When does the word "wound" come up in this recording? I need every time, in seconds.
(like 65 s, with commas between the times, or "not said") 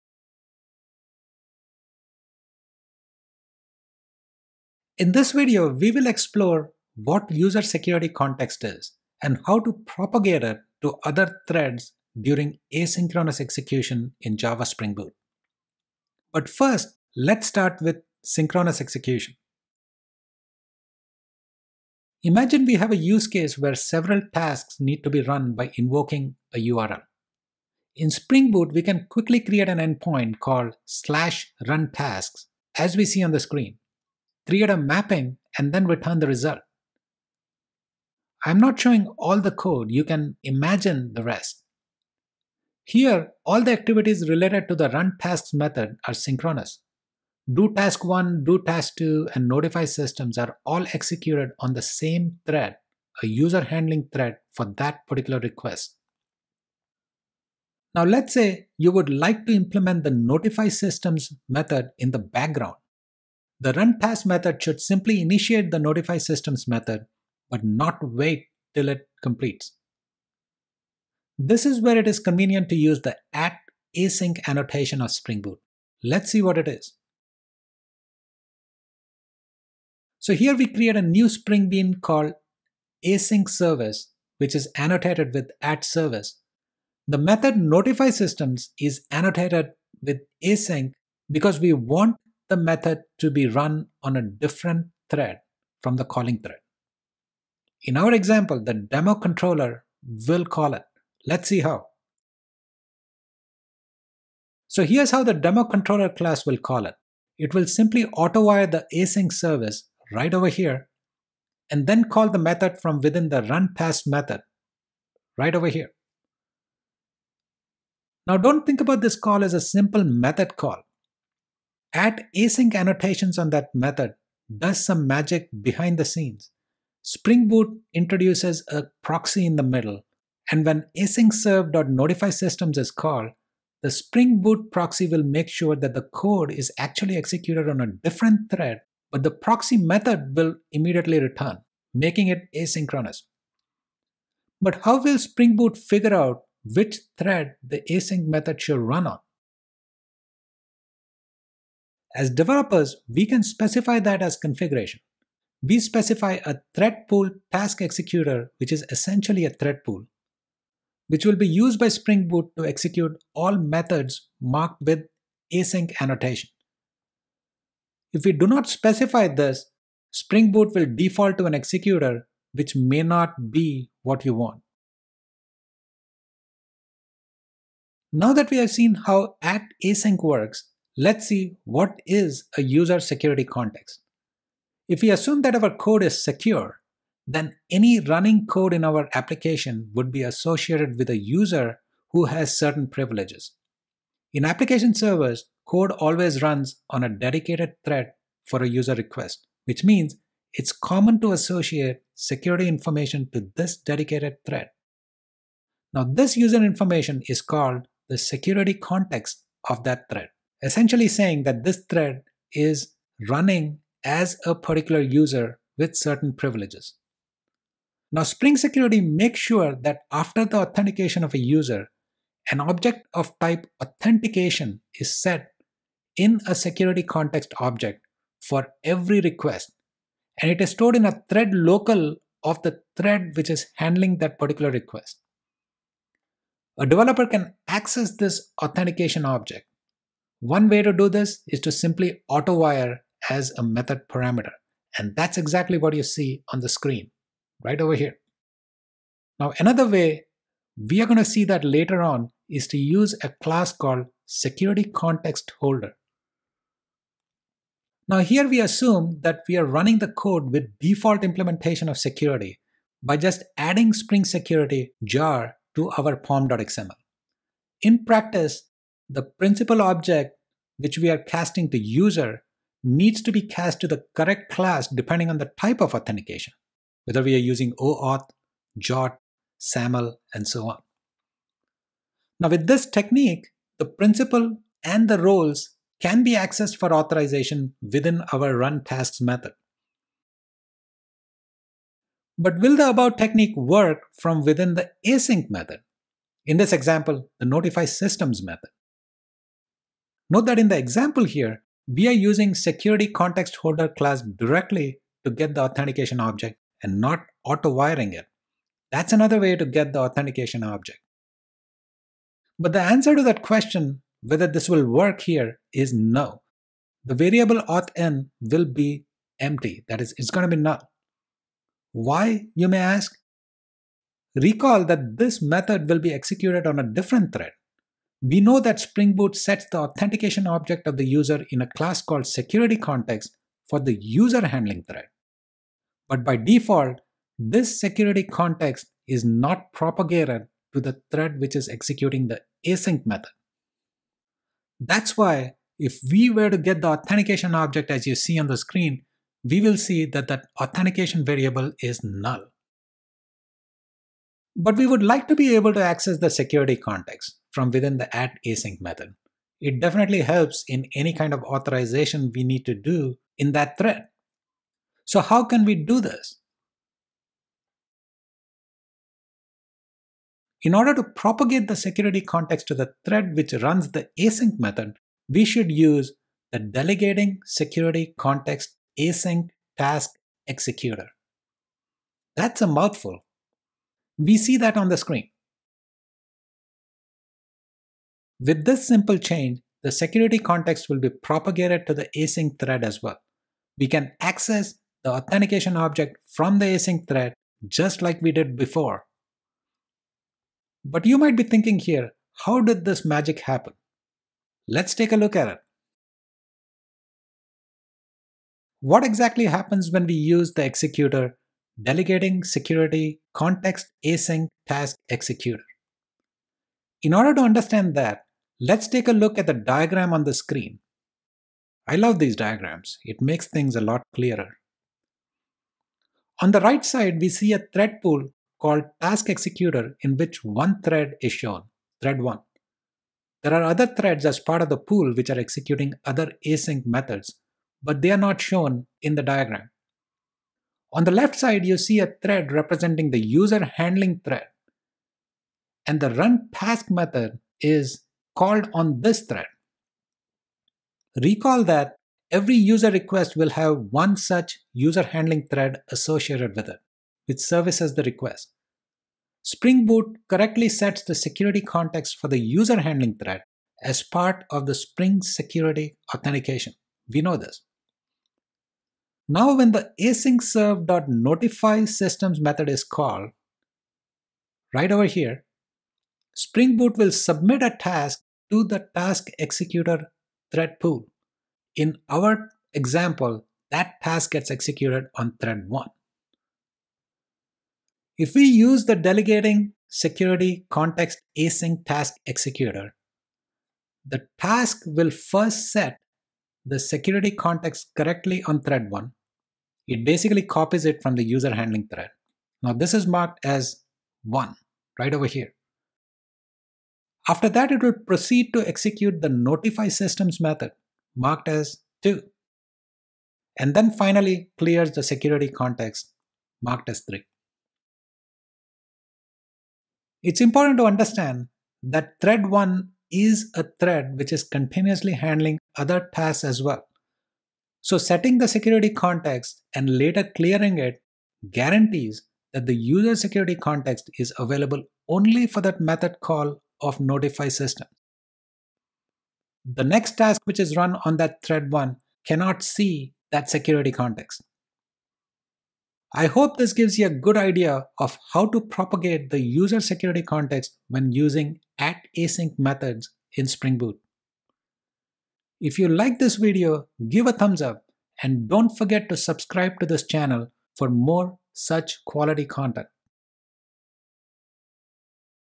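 not said.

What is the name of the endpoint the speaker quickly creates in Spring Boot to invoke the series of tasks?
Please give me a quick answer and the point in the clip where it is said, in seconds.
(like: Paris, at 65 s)
/runTasks, at 30 s.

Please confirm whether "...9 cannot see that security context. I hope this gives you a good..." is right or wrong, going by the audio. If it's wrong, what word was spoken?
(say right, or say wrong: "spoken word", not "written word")
wrong: "1", not "9".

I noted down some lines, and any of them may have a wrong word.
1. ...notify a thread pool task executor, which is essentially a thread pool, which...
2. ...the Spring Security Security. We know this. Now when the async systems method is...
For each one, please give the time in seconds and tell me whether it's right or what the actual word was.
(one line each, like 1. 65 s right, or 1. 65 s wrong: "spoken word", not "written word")
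1. 155 s wrong: "specify", not "notify"
2. 464 s wrong: "Authentication", not "Security".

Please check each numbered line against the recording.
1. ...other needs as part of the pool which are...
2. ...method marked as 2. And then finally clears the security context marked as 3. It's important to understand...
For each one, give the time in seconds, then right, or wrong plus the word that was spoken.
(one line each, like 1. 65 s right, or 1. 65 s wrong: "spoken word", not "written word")
1. 433 s wrong: "threads", not "needs"
2. 510 s right.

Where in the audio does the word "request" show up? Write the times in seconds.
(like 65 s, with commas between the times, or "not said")
55 s, 198 s, 229 s, 234 s, 452 s, 458 s.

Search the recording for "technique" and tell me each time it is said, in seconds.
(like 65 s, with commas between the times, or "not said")
282 s, 293 s.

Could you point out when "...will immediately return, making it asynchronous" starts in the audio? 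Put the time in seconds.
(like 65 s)
140 s.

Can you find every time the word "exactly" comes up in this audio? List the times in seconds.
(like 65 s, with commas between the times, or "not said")
245 s, 409 s.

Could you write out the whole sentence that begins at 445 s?
And the run task method is called on this thread.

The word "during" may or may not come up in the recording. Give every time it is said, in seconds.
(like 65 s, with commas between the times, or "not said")
12 s.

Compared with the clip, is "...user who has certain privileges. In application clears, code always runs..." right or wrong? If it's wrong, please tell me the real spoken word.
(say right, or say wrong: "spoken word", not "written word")
wrong: "servers", not "clears".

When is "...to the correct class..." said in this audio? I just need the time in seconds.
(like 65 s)
273 s.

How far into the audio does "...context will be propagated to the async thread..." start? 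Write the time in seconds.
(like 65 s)
390 s.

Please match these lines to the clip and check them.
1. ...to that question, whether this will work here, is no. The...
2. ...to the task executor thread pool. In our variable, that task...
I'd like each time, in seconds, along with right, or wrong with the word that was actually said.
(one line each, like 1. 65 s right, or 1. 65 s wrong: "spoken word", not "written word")
1. 313 s right
2. 478 s wrong: "example", not "variable".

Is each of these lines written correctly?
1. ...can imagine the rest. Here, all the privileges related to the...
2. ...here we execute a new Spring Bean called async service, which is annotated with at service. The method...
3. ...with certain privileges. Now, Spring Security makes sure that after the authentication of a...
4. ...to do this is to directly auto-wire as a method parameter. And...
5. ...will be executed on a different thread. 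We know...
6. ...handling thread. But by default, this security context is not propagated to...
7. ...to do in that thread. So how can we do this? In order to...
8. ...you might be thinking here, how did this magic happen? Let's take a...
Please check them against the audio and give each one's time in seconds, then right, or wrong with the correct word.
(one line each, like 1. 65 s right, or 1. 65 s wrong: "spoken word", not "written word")
1. 40 s wrong: "activities", not "privileges"
2. 80 s wrong: "create", not "execute"
3. 215 s right
4. 240 s wrong: "simply", not "directly"
5. 325 s right
6. 334 s right
7. 362 s right
8. 401 s right.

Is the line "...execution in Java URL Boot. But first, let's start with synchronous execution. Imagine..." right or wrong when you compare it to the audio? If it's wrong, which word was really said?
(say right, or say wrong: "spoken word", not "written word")
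wrong: "Spring", not "URL".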